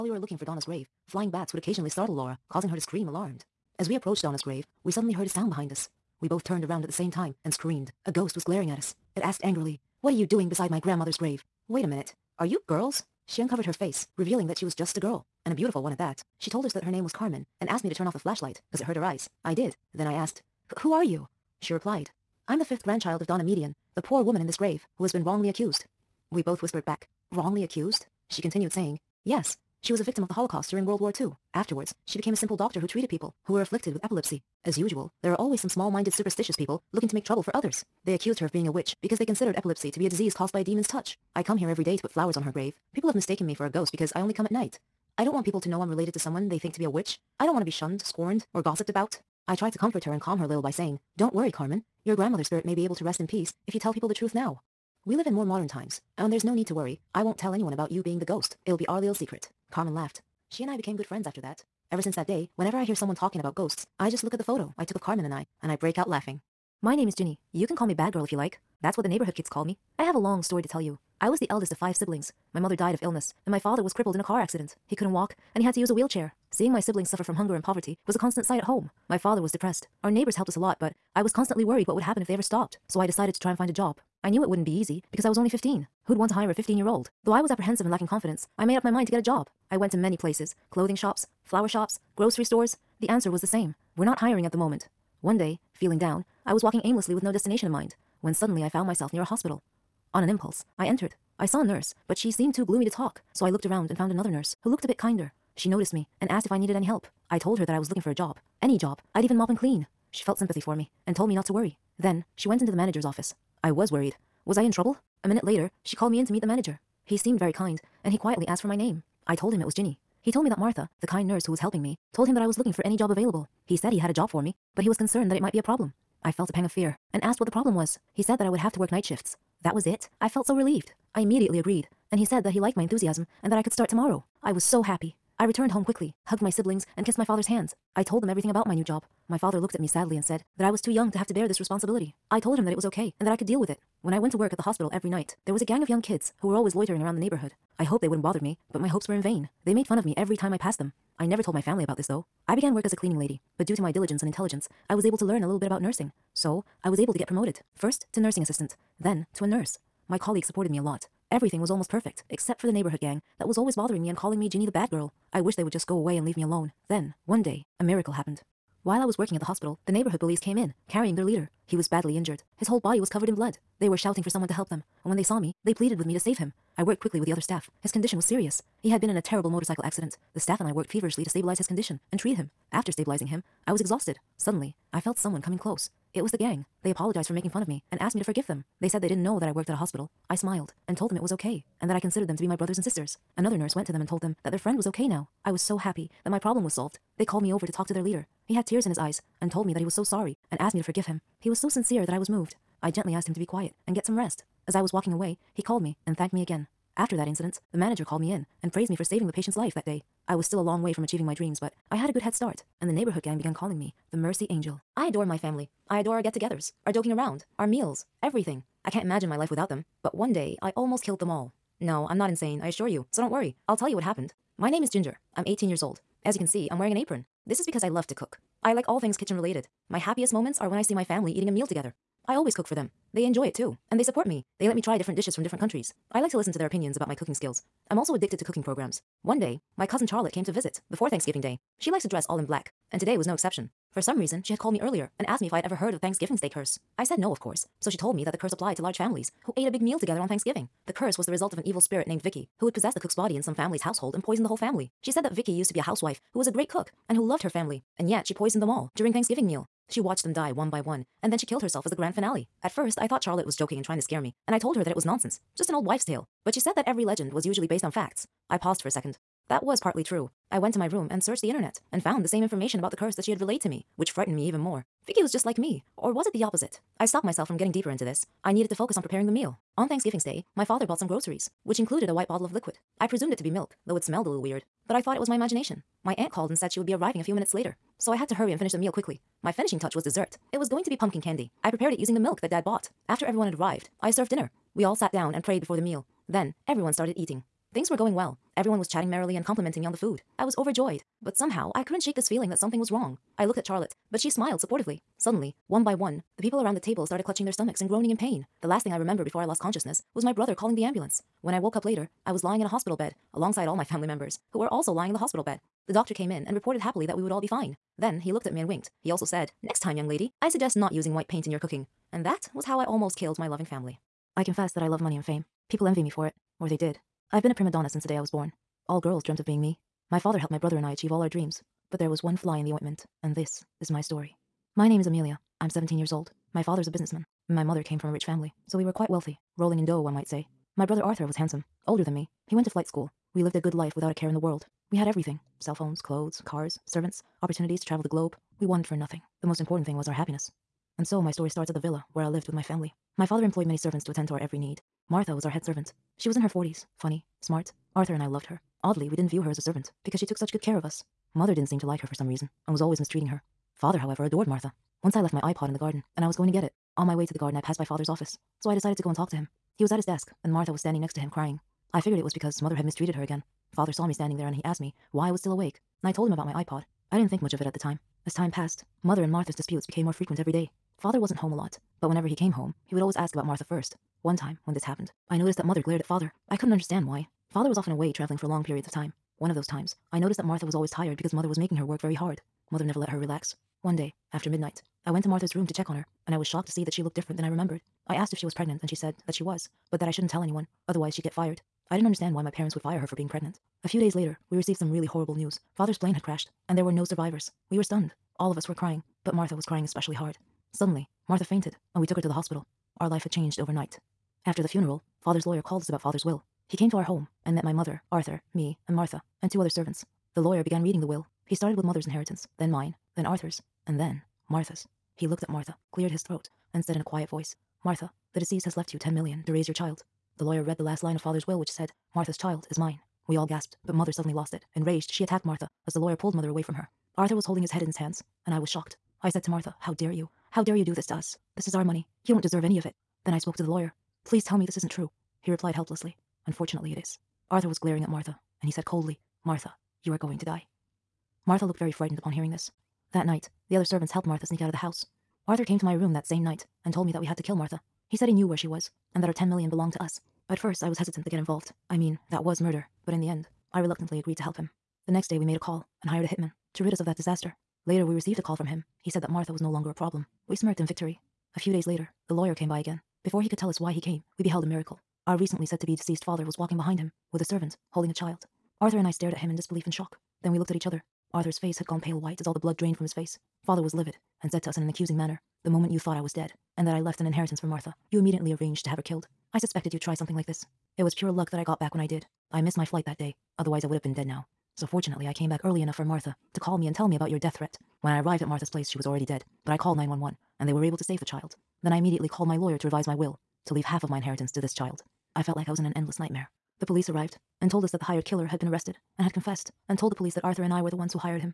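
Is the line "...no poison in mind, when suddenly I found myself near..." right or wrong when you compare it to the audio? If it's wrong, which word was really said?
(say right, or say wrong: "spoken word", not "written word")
wrong: "destination", not "poison".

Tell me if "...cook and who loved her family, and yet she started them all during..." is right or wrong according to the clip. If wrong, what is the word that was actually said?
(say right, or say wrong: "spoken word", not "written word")
wrong: "poisoned", not "started".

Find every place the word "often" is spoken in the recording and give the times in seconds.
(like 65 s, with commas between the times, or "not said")
387 s.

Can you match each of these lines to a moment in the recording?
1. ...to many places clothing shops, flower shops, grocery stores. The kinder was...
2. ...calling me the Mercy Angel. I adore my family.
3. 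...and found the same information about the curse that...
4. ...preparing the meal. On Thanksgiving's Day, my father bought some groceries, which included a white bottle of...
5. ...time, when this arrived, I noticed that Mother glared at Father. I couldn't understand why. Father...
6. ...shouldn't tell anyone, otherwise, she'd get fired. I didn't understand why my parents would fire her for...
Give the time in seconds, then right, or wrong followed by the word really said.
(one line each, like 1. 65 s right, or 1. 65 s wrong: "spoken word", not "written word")
1. 89 s wrong: "answer", not "kinder"
2. 213 s right
3. 271 s right
4. 279 s right
5. 384 s wrong: "happened", not "arrived"
6. 400 s right.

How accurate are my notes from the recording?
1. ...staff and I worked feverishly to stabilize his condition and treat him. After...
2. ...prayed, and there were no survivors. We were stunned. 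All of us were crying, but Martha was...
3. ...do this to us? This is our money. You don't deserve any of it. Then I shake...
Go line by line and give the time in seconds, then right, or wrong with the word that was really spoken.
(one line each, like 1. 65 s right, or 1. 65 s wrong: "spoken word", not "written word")
1. 180 s right
2. 406 s wrong: "crashed", not "prayed"
3. 440 s wrong: "spoke", not "shake".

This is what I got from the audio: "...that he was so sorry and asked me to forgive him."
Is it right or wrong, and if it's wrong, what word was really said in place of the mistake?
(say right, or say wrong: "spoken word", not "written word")
right.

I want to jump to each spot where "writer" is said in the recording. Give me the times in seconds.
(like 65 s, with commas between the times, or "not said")
not said.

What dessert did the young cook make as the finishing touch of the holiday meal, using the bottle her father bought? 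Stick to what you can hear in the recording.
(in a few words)
Pumpkin candy.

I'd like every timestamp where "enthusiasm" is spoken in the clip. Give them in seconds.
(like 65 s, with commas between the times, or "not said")
132 s.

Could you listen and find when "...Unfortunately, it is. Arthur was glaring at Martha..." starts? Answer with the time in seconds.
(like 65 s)
446 s.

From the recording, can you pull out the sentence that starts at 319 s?
He also said, Next time, young lady, I suggest not using white paint in your cooking.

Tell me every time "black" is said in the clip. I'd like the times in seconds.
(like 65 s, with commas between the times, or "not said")
242 s.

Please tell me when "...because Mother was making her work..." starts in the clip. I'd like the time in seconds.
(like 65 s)
391 s.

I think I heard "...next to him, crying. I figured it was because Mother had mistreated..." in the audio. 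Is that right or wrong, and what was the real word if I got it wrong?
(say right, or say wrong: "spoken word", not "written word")
right.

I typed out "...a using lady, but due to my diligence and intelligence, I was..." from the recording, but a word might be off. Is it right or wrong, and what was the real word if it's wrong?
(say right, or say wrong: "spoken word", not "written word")
wrong: "cleaning", not "using".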